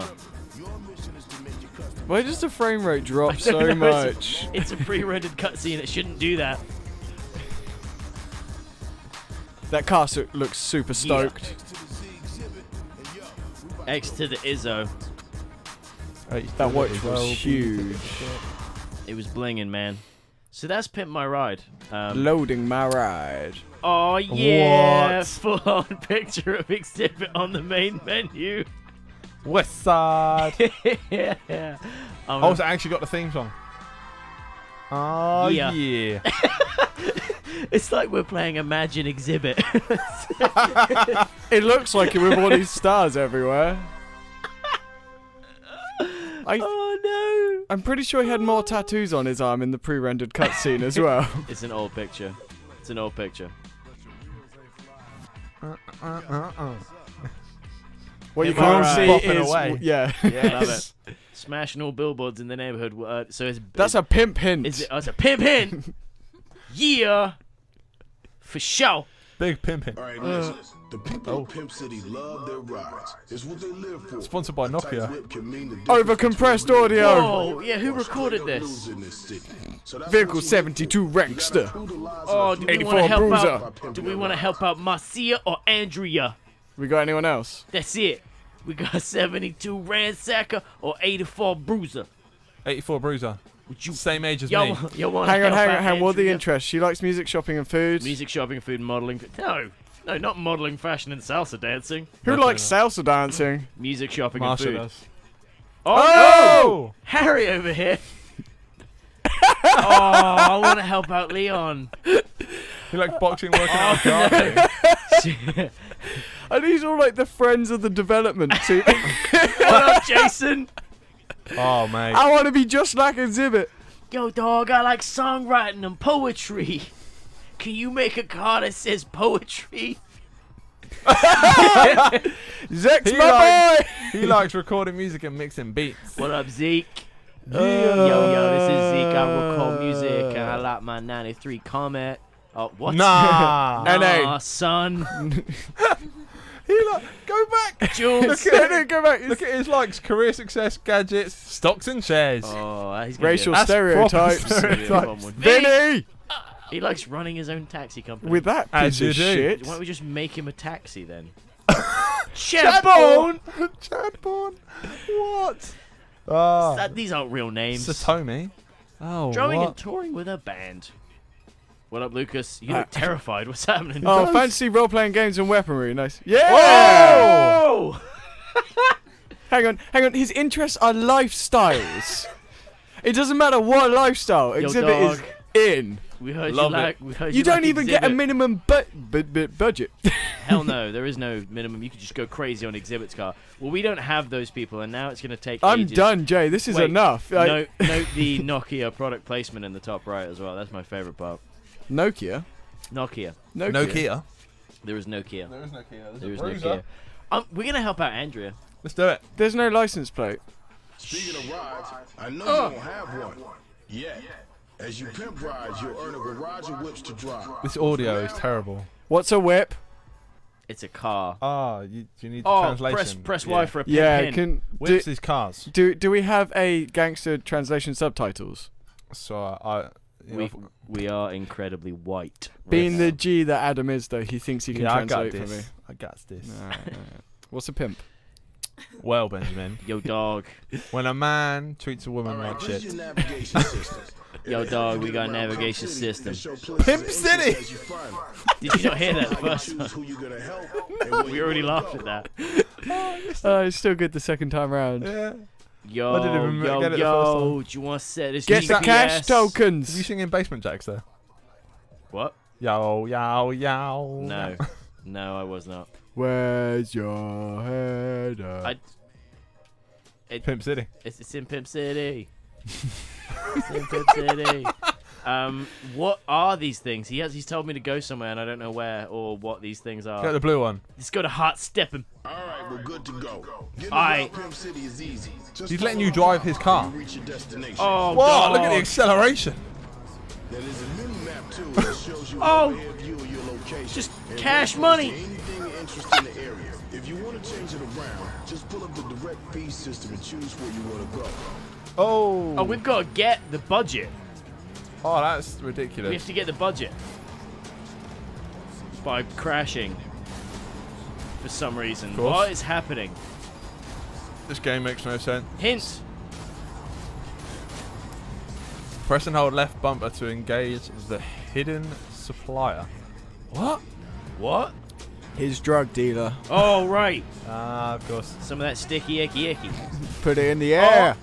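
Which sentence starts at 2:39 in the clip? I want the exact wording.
Why don't we just make him a taxi then?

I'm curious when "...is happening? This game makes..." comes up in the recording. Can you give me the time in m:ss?
5:12.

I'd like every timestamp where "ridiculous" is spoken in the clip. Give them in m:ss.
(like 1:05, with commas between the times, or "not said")
5:05.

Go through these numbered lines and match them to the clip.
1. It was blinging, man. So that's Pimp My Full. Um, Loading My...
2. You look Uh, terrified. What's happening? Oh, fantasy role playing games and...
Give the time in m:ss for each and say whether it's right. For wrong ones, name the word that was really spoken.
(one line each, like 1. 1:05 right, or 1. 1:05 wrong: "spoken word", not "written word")
1. 0:19 wrong: "Ride", not "Full"
2. 2:52 right.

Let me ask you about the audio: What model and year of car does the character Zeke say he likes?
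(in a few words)
93 Comet.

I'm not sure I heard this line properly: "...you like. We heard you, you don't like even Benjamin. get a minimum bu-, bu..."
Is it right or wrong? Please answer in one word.
wrong.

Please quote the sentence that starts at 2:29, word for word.
Look at his likes, career success, gadgets, stocks and shares.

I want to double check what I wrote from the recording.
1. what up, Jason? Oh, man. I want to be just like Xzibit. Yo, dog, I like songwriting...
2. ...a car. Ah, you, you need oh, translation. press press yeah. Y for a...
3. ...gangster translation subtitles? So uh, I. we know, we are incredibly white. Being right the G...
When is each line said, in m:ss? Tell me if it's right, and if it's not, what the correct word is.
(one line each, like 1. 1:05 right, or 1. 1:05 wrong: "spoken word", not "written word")
1. 1:58 right
2. 3:40 right
3. 3:46 right.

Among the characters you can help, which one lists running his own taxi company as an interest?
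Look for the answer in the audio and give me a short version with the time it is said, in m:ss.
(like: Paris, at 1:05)
Vinny, at 2:35.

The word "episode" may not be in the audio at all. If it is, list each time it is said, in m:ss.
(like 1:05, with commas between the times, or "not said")
not said.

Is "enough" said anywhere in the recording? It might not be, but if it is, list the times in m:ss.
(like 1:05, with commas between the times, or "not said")
1:42, 3:16.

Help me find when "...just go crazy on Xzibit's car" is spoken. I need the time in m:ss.
3:12.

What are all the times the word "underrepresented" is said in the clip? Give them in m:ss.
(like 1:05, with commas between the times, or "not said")
not said.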